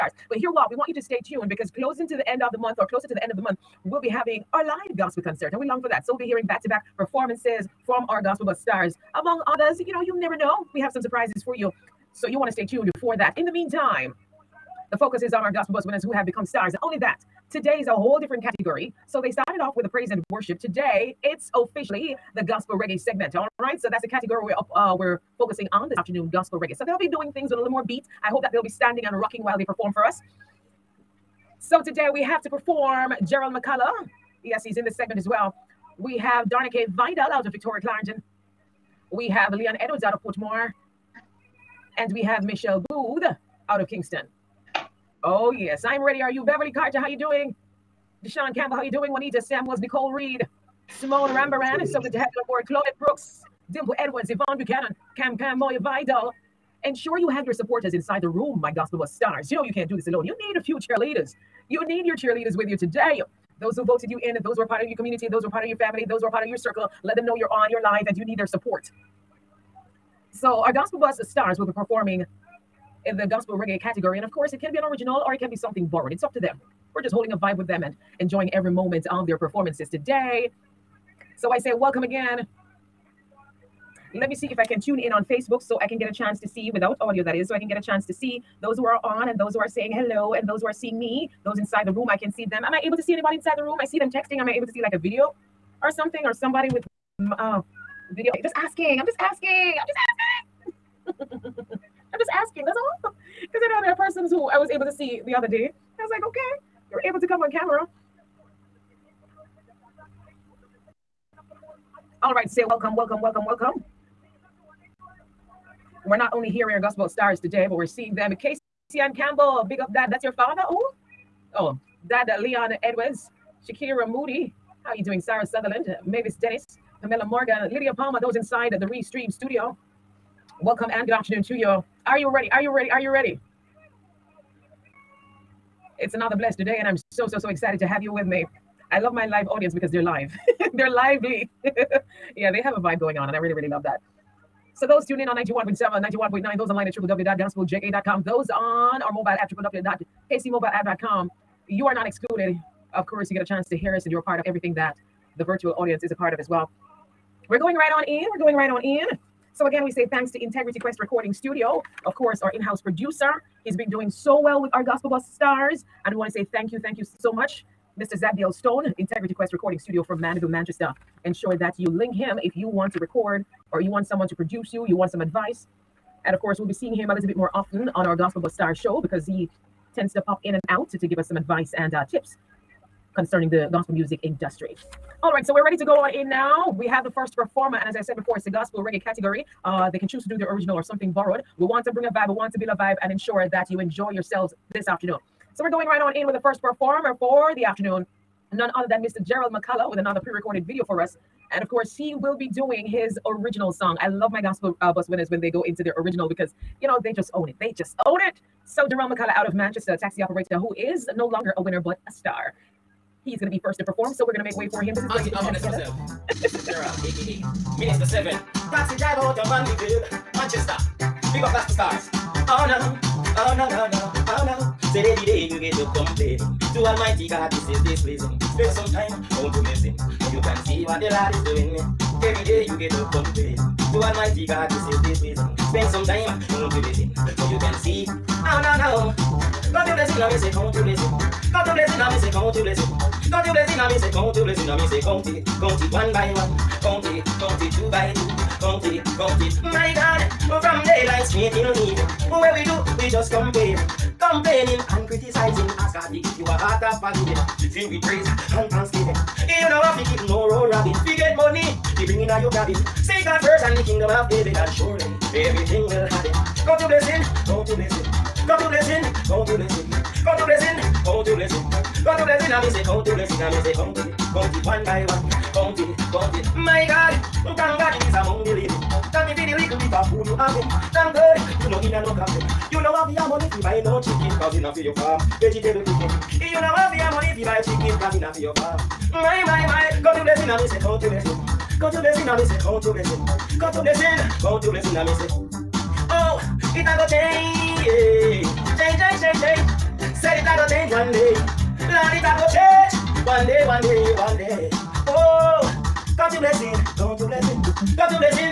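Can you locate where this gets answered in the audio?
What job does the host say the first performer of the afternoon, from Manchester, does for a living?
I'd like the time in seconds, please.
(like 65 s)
209 s.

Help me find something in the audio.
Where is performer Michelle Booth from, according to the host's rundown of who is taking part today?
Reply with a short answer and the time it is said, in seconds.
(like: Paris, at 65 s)
Kingston, at 43 s.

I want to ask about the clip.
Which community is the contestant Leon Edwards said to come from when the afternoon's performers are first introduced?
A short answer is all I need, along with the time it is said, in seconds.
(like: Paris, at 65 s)
Portmore, at 40 s.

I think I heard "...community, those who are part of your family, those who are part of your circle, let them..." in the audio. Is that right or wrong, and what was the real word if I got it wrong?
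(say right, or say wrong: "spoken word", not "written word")
right.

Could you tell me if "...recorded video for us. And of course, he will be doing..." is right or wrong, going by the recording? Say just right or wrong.
right.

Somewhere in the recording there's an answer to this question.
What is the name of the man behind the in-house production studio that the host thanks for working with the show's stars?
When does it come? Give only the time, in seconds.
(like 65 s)
168 s.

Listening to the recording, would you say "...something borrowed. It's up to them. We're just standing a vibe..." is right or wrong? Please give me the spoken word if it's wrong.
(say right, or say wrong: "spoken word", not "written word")
wrong: "holding", not "standing".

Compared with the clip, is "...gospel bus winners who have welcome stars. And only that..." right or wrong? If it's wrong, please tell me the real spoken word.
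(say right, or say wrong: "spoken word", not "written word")
wrong: "become", not "welcome".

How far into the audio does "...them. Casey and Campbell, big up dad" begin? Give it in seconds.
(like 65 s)
118 s.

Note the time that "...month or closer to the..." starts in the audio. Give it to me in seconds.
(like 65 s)
2 s.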